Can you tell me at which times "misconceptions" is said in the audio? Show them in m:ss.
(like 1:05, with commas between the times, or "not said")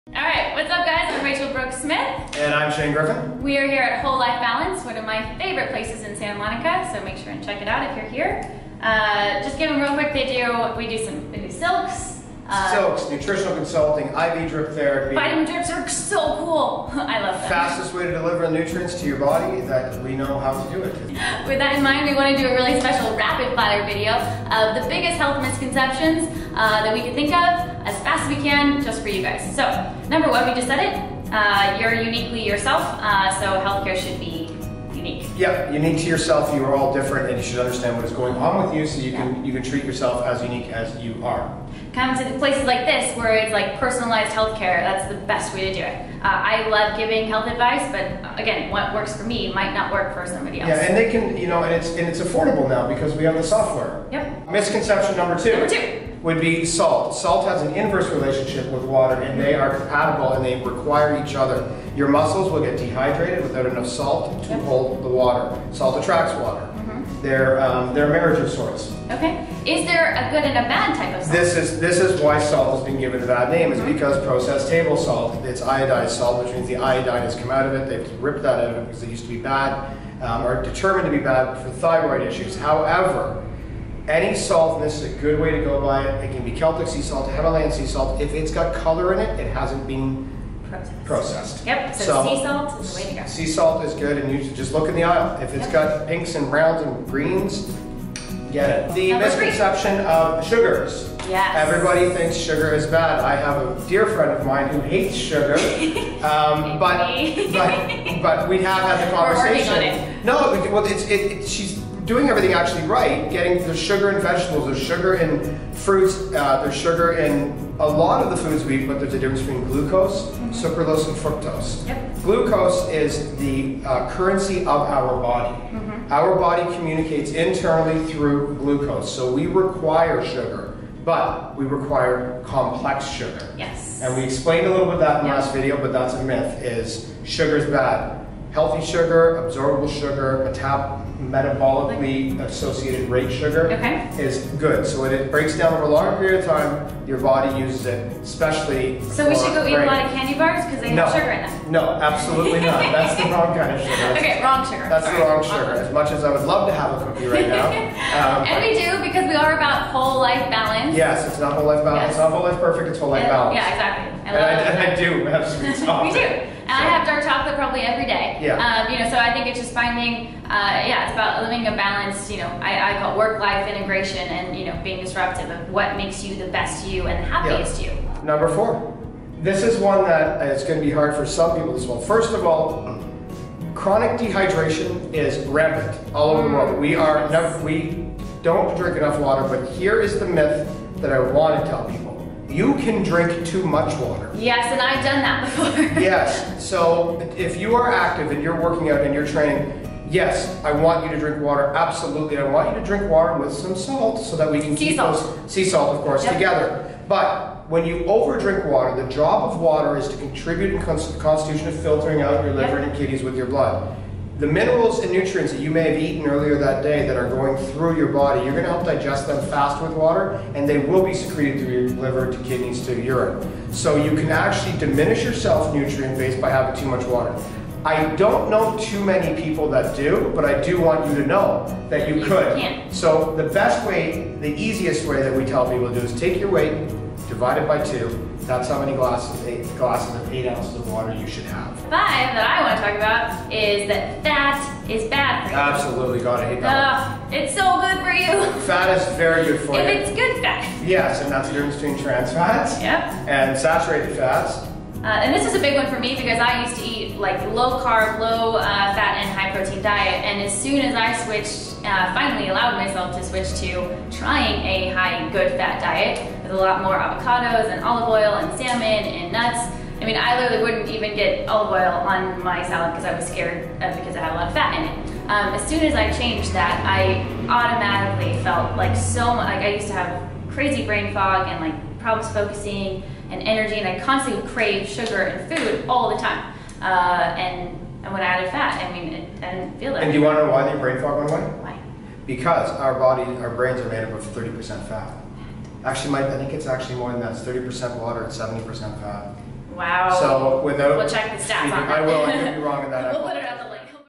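0:25, 0:54, 1:39.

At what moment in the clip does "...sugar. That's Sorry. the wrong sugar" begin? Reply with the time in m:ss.
2:34.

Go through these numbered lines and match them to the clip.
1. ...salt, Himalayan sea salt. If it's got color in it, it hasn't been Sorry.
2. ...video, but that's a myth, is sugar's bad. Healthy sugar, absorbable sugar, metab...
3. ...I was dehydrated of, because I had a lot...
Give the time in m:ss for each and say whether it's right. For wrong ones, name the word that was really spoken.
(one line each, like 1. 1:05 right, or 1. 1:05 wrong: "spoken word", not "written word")
1. 1:27 wrong: "Processed", not "Sorry"
2. 2:15 right
3. 4:33 wrong: "scared", not "dehydrated".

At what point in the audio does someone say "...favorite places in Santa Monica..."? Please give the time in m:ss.
0:05.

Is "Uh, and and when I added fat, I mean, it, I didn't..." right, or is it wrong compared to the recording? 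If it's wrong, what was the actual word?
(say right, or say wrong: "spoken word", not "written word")
right.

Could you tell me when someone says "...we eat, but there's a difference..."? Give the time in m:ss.
1:58.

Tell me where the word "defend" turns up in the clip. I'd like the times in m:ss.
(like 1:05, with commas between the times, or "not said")
not said.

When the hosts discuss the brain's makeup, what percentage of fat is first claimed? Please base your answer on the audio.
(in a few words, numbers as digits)
30%.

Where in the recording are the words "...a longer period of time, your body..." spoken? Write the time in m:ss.
2:25.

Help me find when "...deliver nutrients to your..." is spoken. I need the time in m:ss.
0:18.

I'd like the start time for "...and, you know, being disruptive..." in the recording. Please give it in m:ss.
2:54.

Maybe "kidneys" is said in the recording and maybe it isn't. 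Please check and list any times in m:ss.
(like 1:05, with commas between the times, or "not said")
3:32, 3:42.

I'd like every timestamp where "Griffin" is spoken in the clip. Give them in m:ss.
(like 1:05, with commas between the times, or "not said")
0:02.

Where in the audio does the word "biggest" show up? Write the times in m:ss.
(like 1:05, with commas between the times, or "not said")
0:24.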